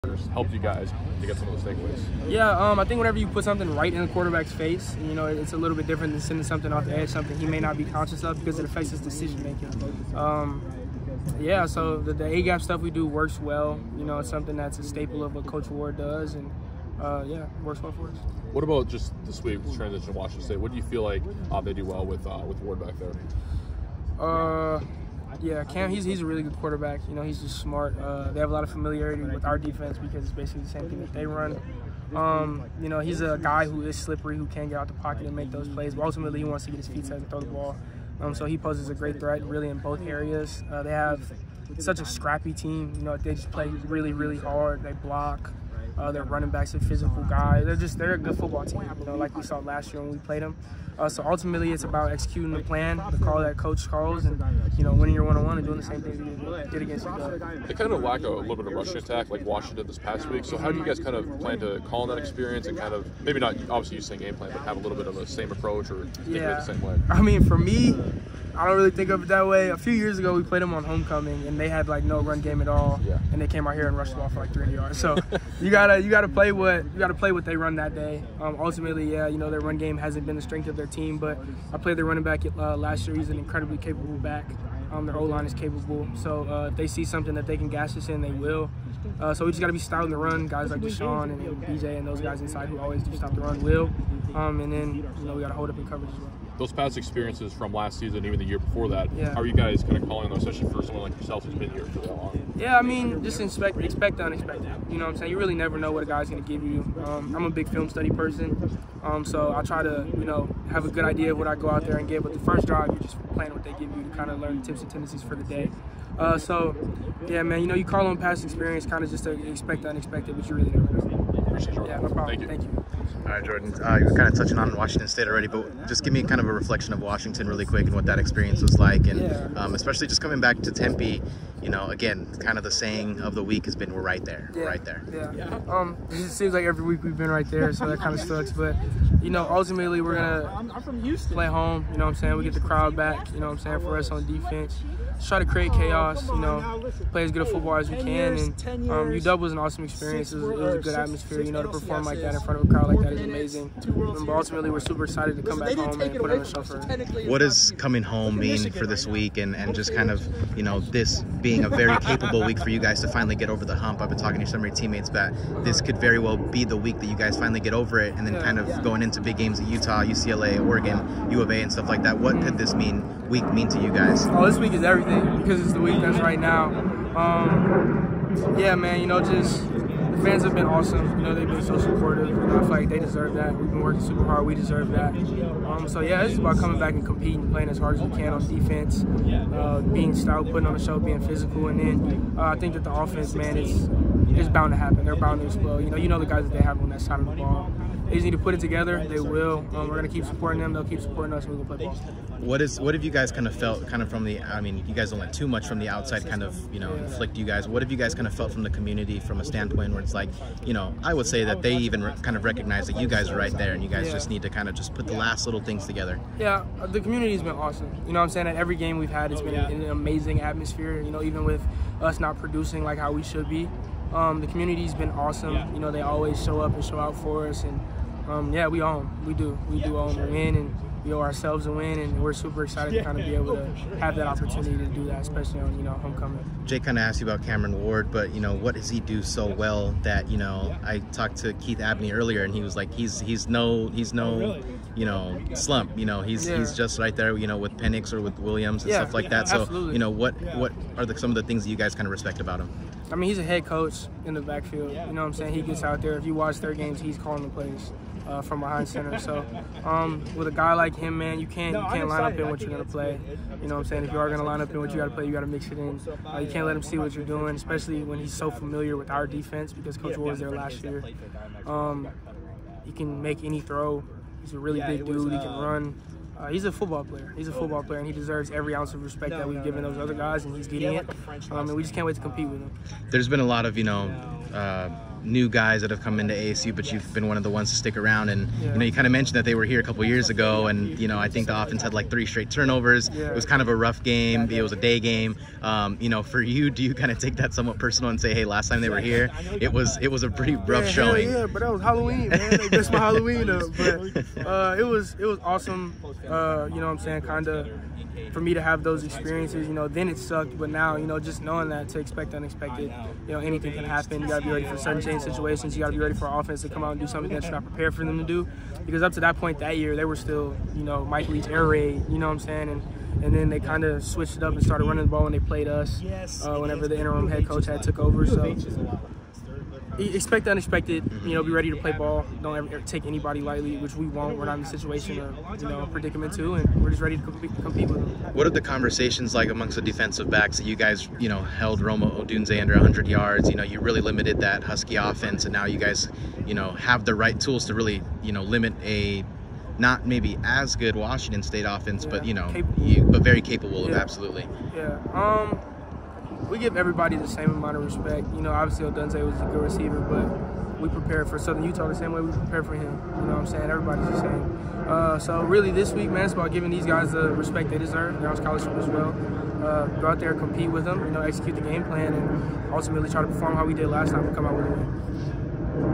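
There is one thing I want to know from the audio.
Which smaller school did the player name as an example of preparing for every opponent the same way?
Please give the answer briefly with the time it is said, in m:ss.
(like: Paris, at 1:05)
Southern Utah, at 6:01.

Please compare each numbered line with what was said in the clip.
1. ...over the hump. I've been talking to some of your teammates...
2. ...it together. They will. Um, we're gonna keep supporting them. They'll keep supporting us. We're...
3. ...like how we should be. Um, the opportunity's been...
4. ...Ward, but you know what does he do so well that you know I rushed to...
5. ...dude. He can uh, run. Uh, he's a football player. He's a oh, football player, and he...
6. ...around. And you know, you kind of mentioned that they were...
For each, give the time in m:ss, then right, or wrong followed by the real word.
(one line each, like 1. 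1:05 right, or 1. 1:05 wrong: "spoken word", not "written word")
1. 2:43 right
2. 3:18 right
3. 3:42 wrong: "community", not "opportunity"
4. 3:57 wrong: "talked", not "rushed"
5. 4:35 right
6. 4:47 right.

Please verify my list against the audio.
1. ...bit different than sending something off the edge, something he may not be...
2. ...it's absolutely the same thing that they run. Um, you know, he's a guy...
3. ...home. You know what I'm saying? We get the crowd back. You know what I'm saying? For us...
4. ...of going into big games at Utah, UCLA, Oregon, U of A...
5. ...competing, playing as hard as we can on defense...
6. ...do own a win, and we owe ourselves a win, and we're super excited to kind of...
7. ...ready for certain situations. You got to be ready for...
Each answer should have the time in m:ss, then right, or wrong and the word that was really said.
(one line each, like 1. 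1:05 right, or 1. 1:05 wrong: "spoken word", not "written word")
1. 0:05 right
2. 0:30 wrong: "basically", not "absolutely"
3. 2:21 right
4. 2:48 right
5. 3:07 right
6. 3:49 right
7. 5:14 right.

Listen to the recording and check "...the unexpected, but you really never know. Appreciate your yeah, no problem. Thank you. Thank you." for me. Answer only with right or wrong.
right.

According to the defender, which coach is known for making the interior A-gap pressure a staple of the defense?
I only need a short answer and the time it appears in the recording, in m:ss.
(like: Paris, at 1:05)
Coach Ward, at 0:15.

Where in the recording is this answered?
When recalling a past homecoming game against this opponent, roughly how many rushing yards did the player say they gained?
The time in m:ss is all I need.
1:14.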